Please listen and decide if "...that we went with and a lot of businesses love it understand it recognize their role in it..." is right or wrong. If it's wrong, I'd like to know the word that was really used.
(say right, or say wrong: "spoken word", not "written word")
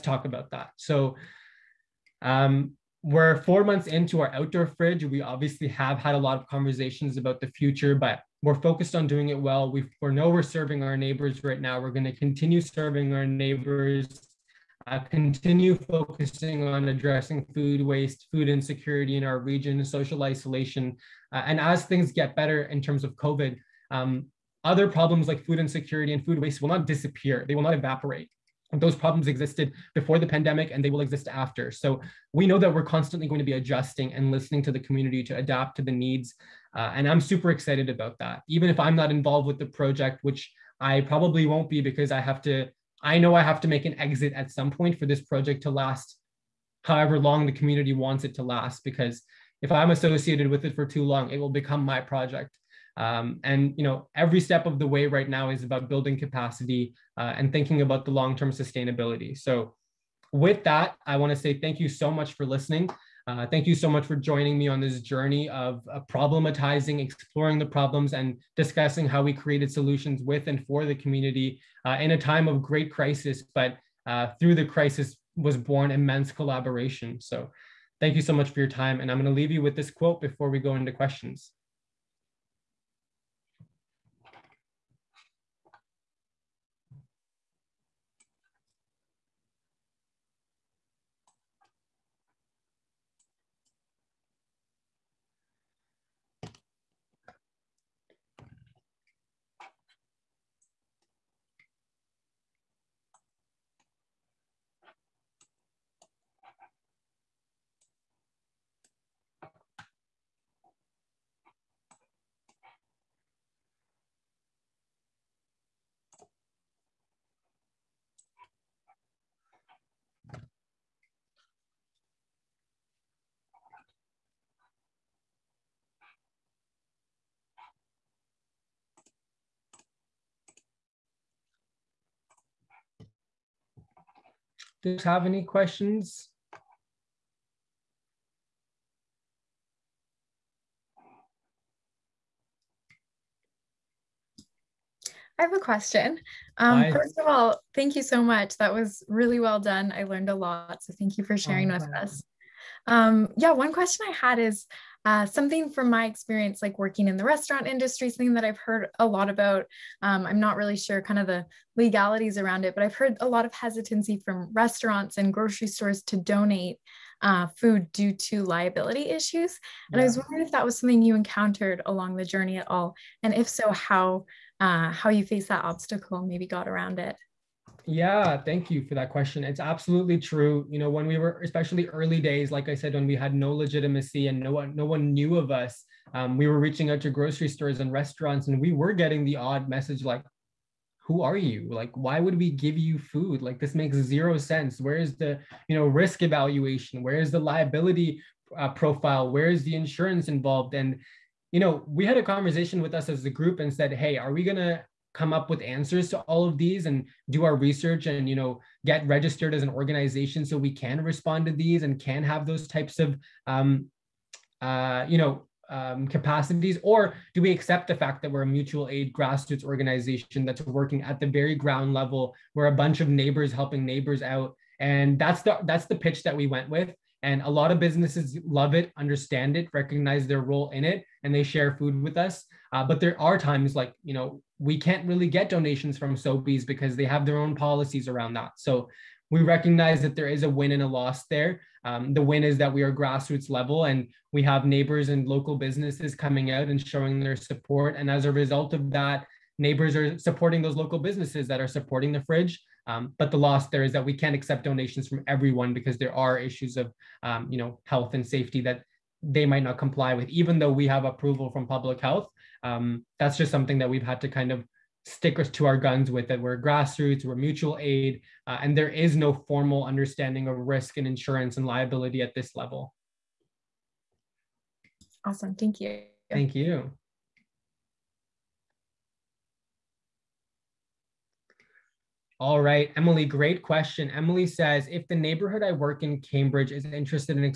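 right.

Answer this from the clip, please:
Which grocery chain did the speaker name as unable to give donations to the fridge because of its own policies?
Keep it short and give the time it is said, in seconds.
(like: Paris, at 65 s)
Sobeys, at 236 s.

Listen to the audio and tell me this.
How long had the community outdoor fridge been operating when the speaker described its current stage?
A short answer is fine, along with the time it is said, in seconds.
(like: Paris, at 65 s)
4 months, at 3 s.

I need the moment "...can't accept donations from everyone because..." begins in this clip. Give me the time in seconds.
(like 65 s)
254 s.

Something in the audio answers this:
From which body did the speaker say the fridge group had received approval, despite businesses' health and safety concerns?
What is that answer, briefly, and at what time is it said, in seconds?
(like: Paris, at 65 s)
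public health, at 261 s.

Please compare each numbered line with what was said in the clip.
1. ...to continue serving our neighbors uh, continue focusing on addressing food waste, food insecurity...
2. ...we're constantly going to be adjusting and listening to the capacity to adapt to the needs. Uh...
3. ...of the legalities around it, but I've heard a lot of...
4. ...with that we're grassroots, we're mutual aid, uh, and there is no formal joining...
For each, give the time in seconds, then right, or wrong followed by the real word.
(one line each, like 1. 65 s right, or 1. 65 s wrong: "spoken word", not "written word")
1. 12 s right
2. 32 s wrong: "community", not "capacity"
3. 161 s right
4. 266 s wrong: "understanding", not "joining".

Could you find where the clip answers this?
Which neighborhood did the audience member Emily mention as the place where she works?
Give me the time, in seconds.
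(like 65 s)
286 s.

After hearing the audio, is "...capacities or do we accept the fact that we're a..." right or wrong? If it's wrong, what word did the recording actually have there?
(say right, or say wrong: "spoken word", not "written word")
right.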